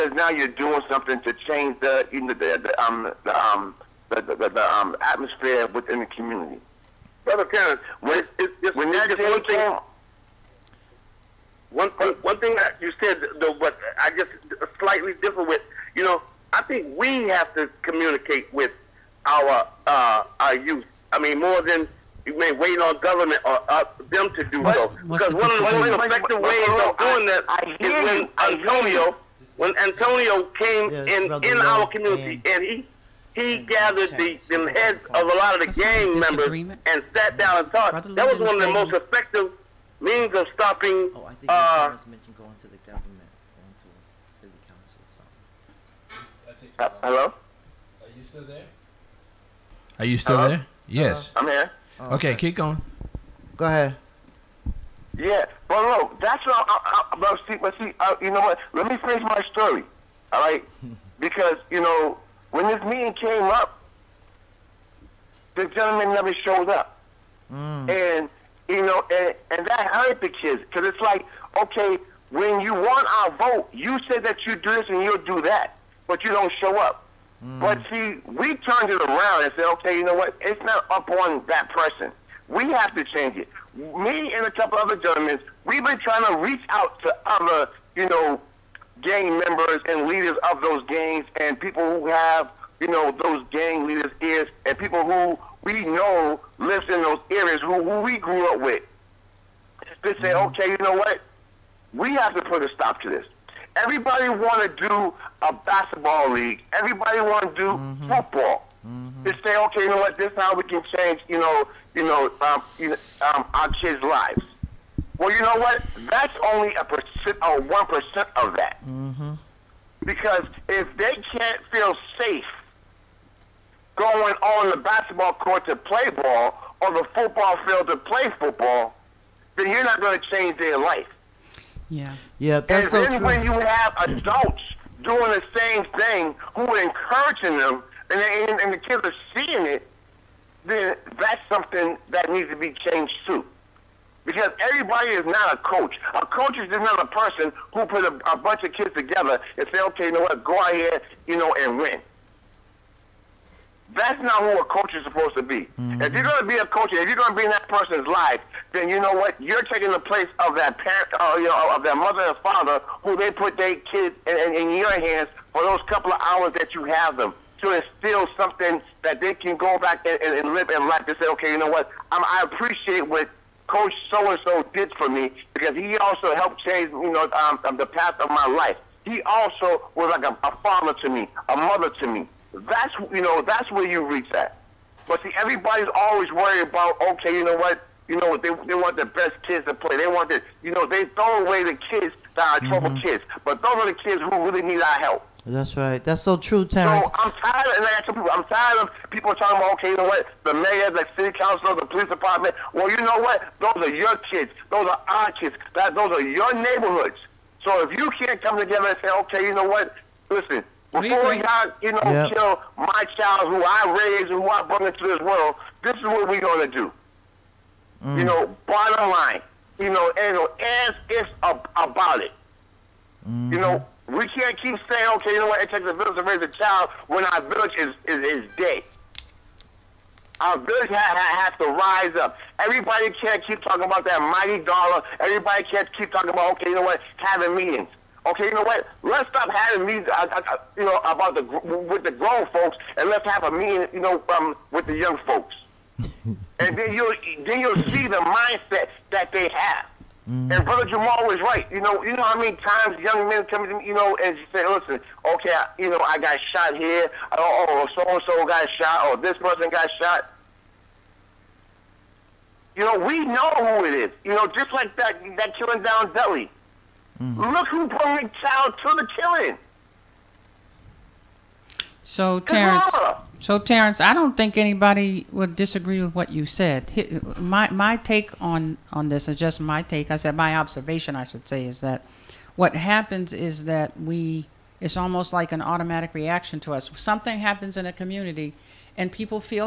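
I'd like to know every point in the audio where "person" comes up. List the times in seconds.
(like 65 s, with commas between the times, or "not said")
81 s, 147 s, 157 s, 259 s.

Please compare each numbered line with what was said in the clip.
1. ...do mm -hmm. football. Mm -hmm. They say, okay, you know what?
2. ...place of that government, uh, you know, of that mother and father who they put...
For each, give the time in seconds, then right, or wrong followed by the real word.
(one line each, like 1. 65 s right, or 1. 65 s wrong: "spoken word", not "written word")
1. 107 s right
2. 160 s wrong: "parent", not "government".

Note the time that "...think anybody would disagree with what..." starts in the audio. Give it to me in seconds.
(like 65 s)
274 s.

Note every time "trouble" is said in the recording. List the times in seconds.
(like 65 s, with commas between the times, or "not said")
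192 s.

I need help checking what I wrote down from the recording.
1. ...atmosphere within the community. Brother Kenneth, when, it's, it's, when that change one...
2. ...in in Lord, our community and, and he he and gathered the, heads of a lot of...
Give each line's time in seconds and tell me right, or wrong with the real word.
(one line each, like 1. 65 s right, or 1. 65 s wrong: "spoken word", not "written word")
1. 5 s right
2. 31 s right.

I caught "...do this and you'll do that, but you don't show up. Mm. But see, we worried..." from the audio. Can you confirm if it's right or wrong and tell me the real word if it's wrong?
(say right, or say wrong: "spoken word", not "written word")
wrong: "turned", not "worried".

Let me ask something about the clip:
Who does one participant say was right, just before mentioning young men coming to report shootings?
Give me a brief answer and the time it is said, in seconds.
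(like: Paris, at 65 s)
Brother Jamal, at 250 s.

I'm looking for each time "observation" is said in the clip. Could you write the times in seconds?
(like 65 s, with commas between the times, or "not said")
280 s.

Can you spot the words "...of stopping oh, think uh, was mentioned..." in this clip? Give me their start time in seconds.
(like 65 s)
40 s.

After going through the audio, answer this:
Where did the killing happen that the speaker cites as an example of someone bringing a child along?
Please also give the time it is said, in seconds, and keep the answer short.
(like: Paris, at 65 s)
Delhi, at 266 s.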